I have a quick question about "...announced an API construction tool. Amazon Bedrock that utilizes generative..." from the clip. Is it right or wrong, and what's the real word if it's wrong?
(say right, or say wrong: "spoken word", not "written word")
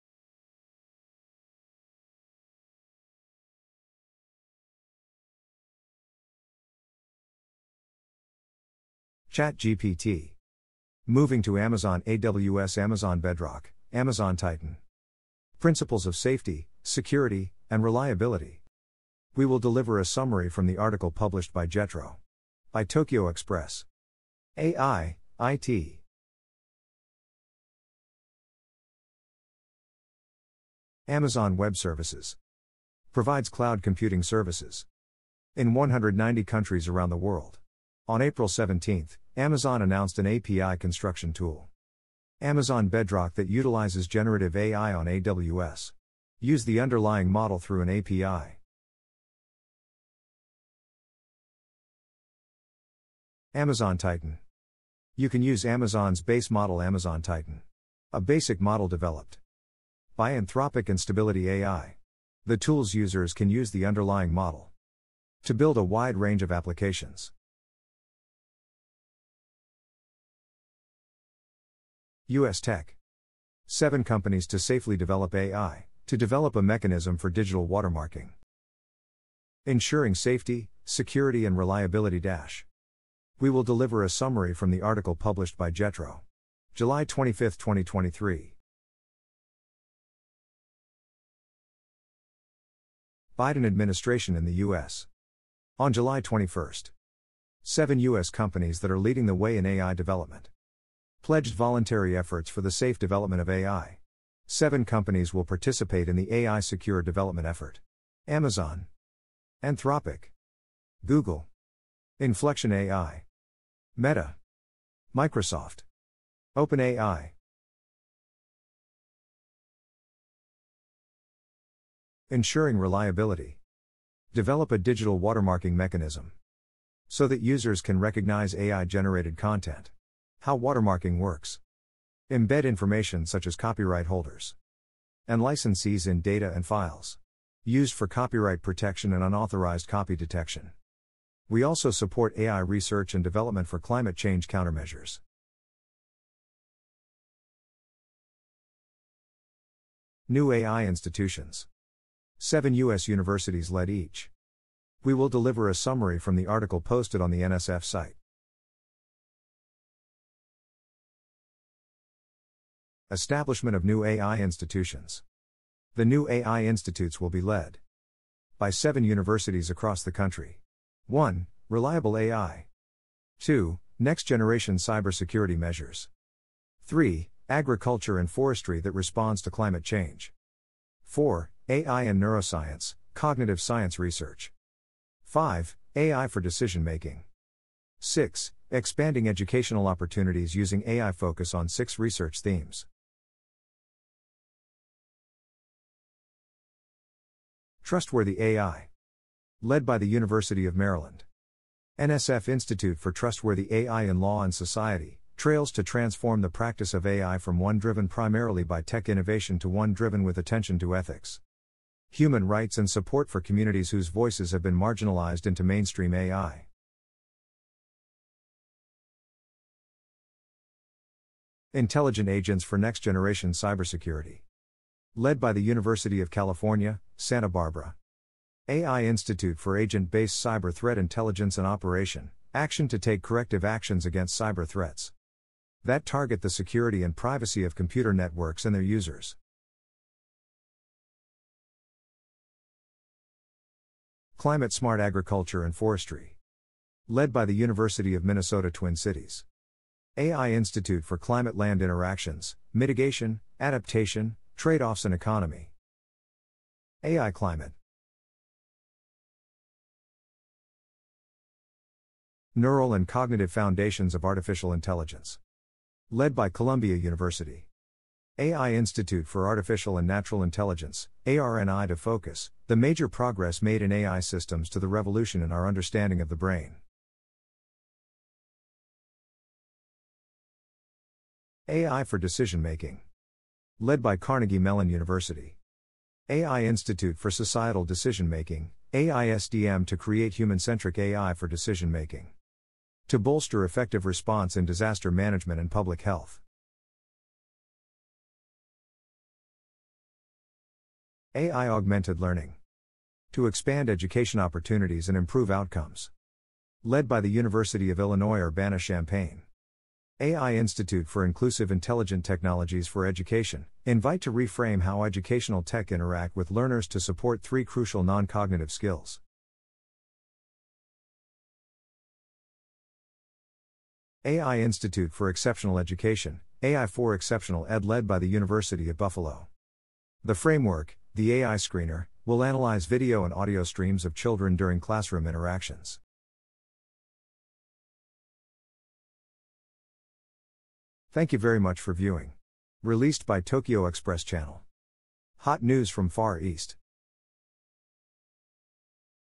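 right.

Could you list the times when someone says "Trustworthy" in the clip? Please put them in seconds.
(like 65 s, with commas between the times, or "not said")
197 s, 203 s.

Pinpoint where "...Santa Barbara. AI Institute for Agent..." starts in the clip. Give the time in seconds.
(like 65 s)
227 s.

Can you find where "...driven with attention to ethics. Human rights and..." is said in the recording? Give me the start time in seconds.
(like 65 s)
209 s.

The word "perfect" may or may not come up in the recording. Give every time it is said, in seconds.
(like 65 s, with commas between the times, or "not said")
not said.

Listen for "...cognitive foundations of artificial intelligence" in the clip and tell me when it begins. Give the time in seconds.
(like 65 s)
263 s.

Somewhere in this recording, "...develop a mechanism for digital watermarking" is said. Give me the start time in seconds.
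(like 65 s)
76 s.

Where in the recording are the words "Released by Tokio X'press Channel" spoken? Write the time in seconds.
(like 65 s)
342 s.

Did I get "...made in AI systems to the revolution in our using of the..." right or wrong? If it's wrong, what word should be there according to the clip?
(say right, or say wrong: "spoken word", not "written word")
wrong: "understanding", not "using".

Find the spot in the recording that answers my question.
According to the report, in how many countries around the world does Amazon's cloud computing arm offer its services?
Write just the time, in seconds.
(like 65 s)
35 s.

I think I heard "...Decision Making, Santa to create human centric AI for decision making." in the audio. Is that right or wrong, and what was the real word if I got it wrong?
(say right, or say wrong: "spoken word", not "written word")
wrong: "AISDM", not "Santa".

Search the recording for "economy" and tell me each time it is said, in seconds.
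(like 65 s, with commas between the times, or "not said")
255 s.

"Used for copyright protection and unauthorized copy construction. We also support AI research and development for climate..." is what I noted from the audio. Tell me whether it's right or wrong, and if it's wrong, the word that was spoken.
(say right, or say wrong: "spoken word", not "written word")
wrong: "detection", not "construction".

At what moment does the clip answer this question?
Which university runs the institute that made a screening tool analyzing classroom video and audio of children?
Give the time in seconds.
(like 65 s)
328 s.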